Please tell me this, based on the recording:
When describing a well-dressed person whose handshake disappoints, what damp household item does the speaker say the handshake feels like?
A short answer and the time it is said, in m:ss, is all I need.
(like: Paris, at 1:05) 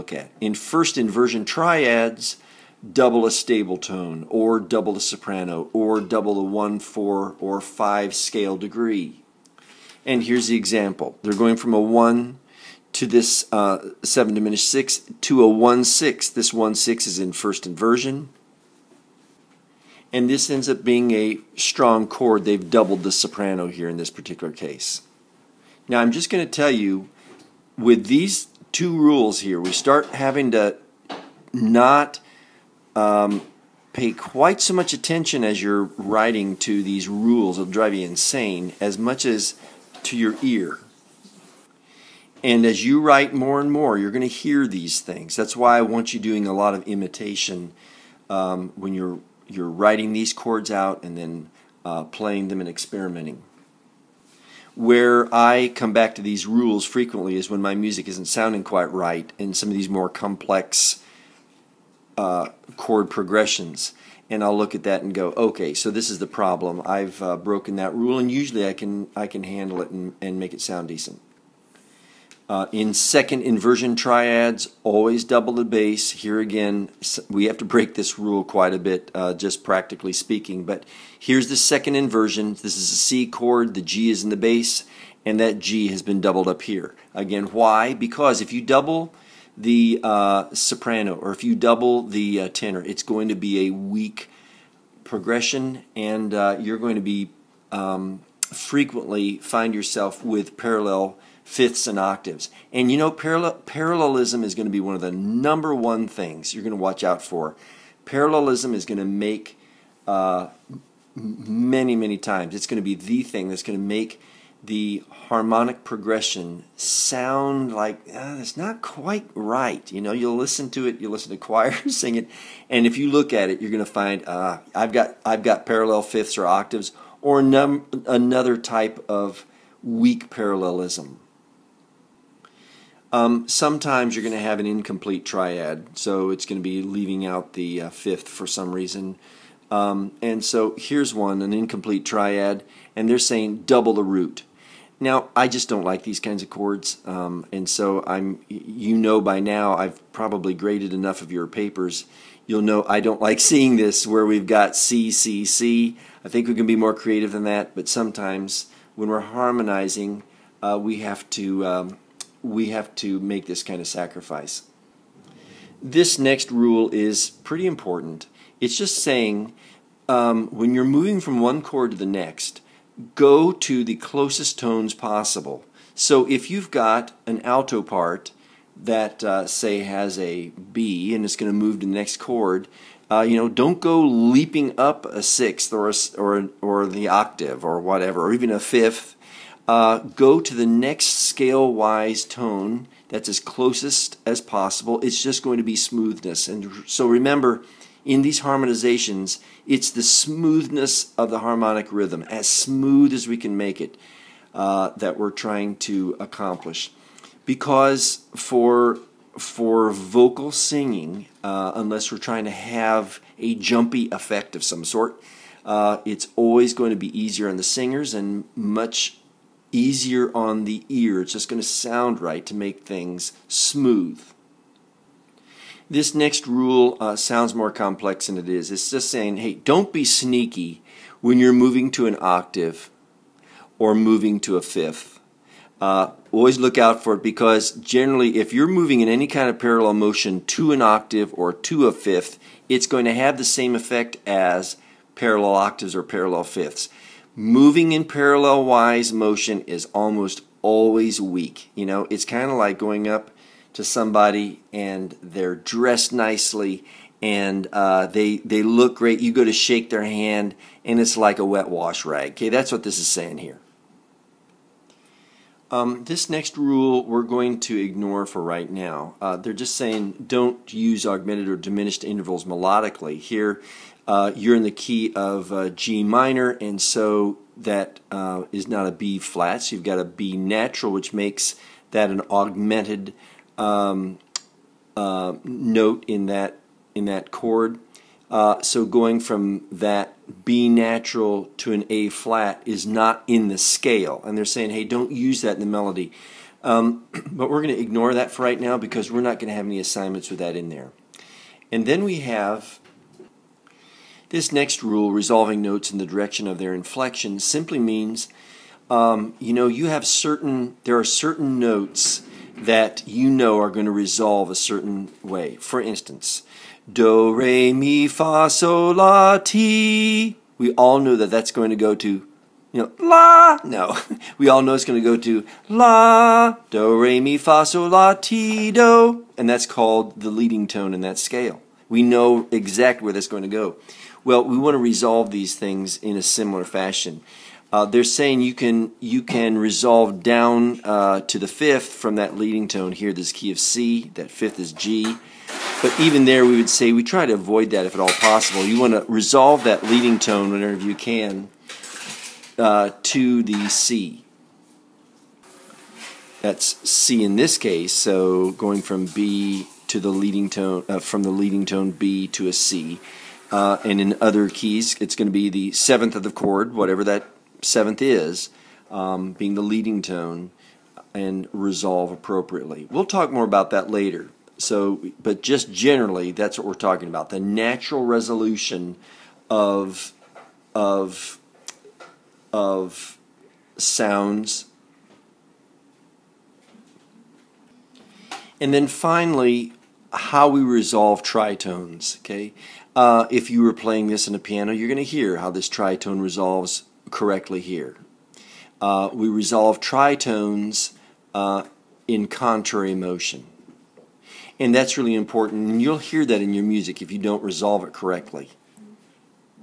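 wet wash rag, at 4:21.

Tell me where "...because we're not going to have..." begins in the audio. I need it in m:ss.
4:58.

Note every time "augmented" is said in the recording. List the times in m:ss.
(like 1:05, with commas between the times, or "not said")
4:31, 4:42.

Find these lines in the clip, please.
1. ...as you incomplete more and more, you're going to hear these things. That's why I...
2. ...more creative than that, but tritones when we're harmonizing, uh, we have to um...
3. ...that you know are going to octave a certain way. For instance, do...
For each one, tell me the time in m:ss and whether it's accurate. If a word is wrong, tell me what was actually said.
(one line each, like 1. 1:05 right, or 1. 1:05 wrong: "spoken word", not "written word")
1. 0:42 wrong: "write", not "incomplete"
2. 2:36 wrong: "sometimes", not "tritones"
3. 5:12 wrong: "resolve", not "octave".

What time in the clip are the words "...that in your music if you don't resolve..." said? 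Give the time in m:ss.
6:46.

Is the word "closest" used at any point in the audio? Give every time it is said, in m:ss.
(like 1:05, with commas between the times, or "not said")
2:53, 3:13.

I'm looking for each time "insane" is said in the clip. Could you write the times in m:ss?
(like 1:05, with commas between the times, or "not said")
0:38.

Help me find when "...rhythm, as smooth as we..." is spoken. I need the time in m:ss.
3:21.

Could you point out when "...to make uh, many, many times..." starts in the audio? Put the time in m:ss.
1:48.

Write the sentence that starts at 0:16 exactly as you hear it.
This 1 6 is in first inversion.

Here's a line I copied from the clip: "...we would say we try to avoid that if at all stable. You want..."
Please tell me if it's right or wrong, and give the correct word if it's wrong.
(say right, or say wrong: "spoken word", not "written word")
wrong: "possible", not "stable".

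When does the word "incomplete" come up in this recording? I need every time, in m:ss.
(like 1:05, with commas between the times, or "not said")
2:14, 2:21.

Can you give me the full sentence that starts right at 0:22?
They've doubled the soprano here in this particular case.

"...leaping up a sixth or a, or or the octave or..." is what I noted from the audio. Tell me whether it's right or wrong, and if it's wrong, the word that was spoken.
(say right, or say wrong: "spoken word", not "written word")
right.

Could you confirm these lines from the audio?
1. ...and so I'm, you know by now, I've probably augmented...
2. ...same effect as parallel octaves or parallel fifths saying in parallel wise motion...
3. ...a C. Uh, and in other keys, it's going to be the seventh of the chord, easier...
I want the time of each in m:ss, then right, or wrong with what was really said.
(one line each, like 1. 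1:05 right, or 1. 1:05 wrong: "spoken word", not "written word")
1. 2:27 wrong: "graded", not "augmented"
2. 4:03 wrong: "moving", not "saying"
3. 6:02 wrong: "whatever", not "easier".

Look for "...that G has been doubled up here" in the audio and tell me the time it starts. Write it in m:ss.
1:25.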